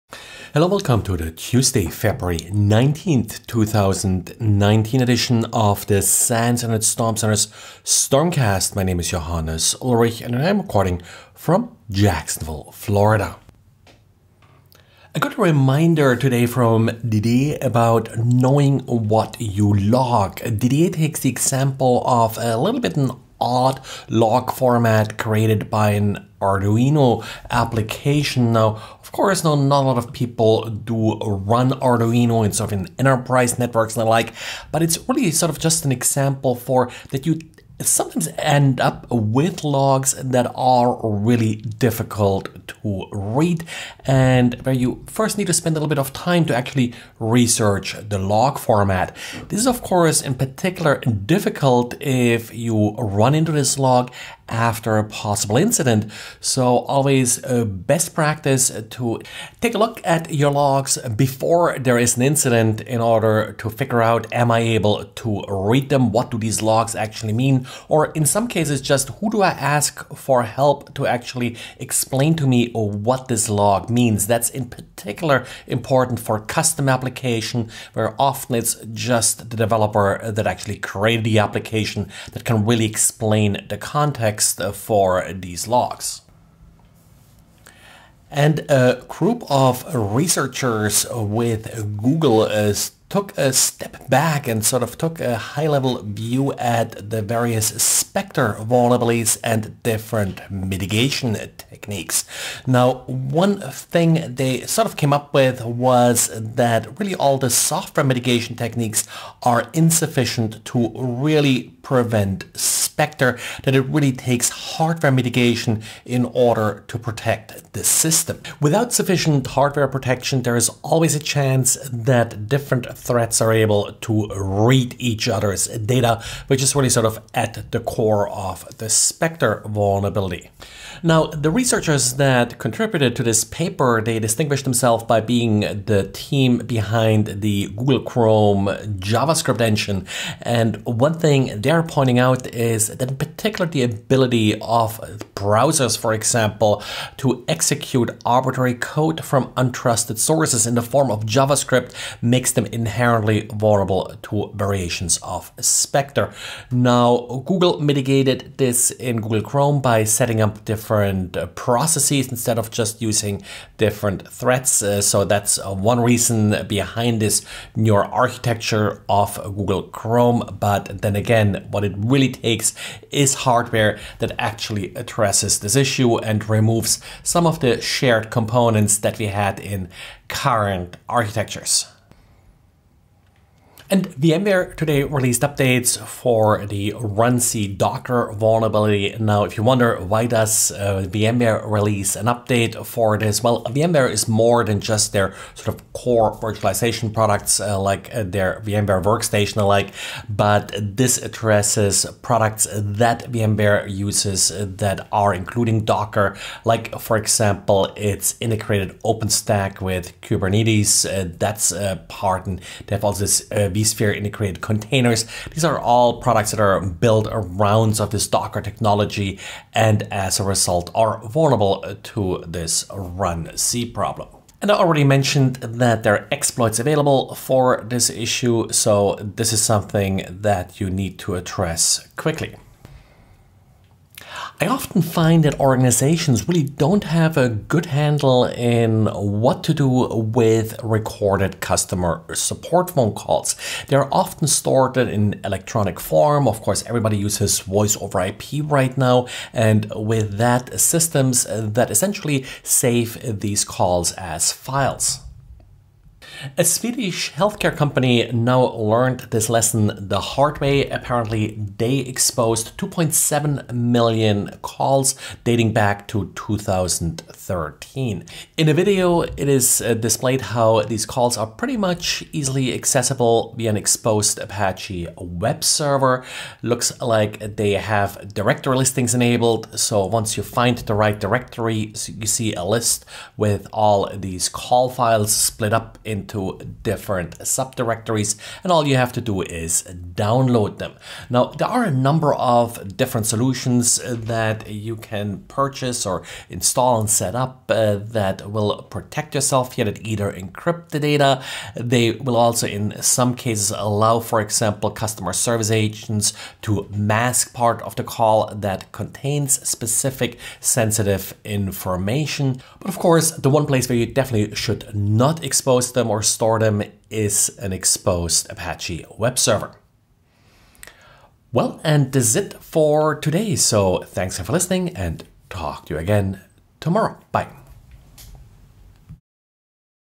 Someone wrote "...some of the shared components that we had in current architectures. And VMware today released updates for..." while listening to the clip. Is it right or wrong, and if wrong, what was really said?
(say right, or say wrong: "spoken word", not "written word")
right.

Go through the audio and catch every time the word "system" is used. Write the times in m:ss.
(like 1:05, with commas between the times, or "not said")
1:57, 4:10.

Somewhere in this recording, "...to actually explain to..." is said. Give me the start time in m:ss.
1:10.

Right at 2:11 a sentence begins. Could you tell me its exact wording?
Now, the researchers that contributed to this paper, they distinguished themselves by being the team behind the Google Chrome JavaScript engine.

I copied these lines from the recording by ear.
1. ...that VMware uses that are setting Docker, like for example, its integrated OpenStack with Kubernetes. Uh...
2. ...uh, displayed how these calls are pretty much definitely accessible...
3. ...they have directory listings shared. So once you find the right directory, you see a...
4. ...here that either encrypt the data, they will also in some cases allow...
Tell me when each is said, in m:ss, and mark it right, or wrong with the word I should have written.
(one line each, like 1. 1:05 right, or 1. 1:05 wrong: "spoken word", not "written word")
1. 3:22 wrong: "including", not "setting"
2. 4:29 wrong: "easily", not "definitely"
3. 4:37 wrong: "enabled", not "shared"
4. 4:59 right.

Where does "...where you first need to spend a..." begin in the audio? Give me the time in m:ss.
0:44.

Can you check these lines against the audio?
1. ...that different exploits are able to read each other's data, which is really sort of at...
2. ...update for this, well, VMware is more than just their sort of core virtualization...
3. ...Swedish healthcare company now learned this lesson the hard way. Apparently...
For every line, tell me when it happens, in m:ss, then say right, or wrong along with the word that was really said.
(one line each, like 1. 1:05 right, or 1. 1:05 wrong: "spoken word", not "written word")
1. 2:01 wrong: "threats", not "exploits"
2. 3:12 right
3. 4:16 right.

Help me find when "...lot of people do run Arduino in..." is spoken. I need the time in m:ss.
0:29.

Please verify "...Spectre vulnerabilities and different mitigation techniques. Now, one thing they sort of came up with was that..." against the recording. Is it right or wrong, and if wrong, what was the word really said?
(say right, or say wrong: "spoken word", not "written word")
right.